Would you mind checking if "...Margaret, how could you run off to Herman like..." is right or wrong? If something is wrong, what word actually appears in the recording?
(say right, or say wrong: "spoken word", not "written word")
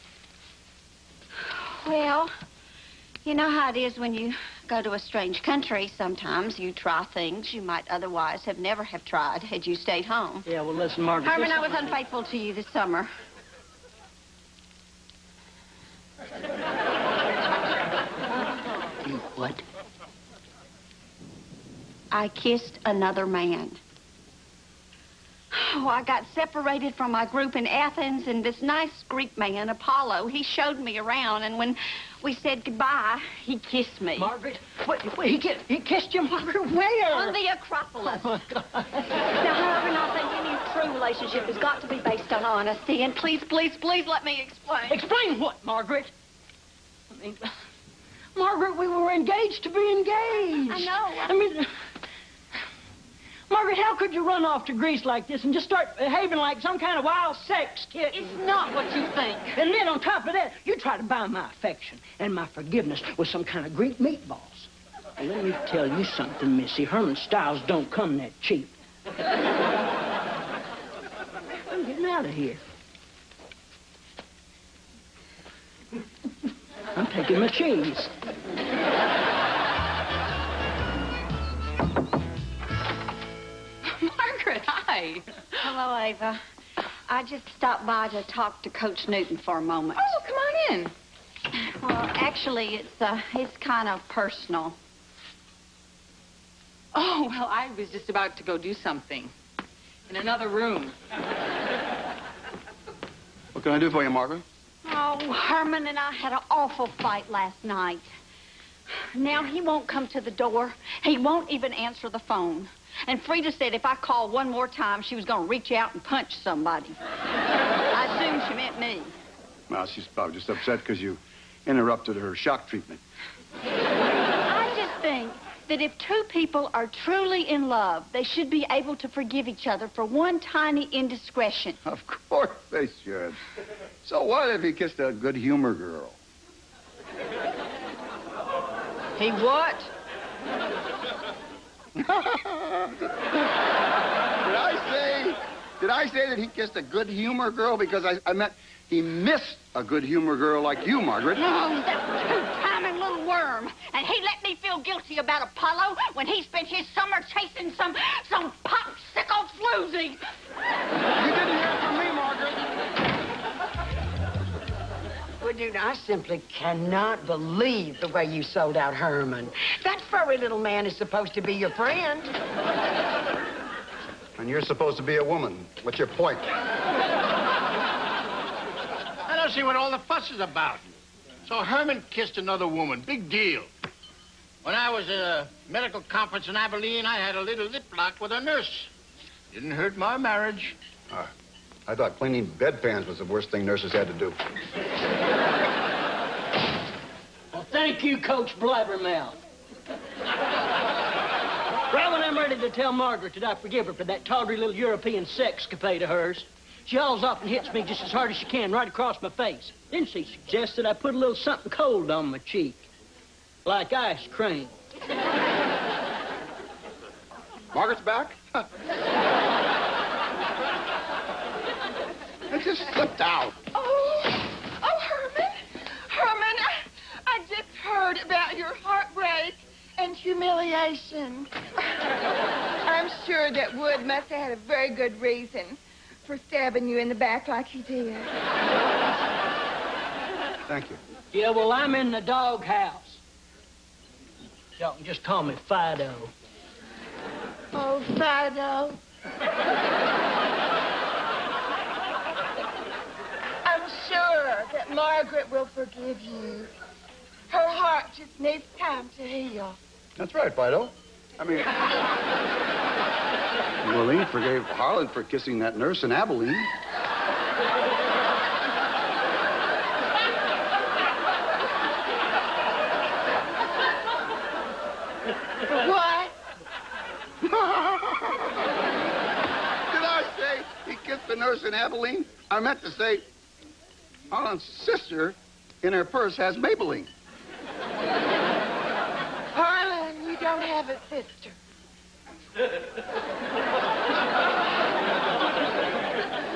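wrong: "Greece", not "Herman".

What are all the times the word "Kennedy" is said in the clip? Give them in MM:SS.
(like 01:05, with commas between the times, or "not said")
not said.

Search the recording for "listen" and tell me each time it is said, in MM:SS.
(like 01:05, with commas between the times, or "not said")
00:10.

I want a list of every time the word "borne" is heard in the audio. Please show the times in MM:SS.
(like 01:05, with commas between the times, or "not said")
not said.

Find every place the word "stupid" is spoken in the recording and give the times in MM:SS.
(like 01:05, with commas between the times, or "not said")
not said.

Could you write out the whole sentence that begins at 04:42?
I meant to say Harlan's sister in her purse has Maybelline.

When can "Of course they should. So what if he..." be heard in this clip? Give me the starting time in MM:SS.
02:11.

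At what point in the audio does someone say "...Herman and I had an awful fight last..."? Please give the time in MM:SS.
01:45.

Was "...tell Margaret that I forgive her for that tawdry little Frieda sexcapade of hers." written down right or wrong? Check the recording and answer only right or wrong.
wrong.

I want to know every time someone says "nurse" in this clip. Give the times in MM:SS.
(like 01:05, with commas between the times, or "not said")
03:08, 03:13, 04:25, 04:41.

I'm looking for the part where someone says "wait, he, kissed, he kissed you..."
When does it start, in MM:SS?
00:35.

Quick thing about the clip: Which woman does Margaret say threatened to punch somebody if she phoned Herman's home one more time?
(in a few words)
Frieda.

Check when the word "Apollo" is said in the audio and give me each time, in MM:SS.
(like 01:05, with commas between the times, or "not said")
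00:29, 02:35.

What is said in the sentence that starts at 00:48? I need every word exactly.
Margaret, we were engaged to be engaged.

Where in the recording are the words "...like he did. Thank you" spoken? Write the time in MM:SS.
03:57.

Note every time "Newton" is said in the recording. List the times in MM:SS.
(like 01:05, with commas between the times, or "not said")
01:29.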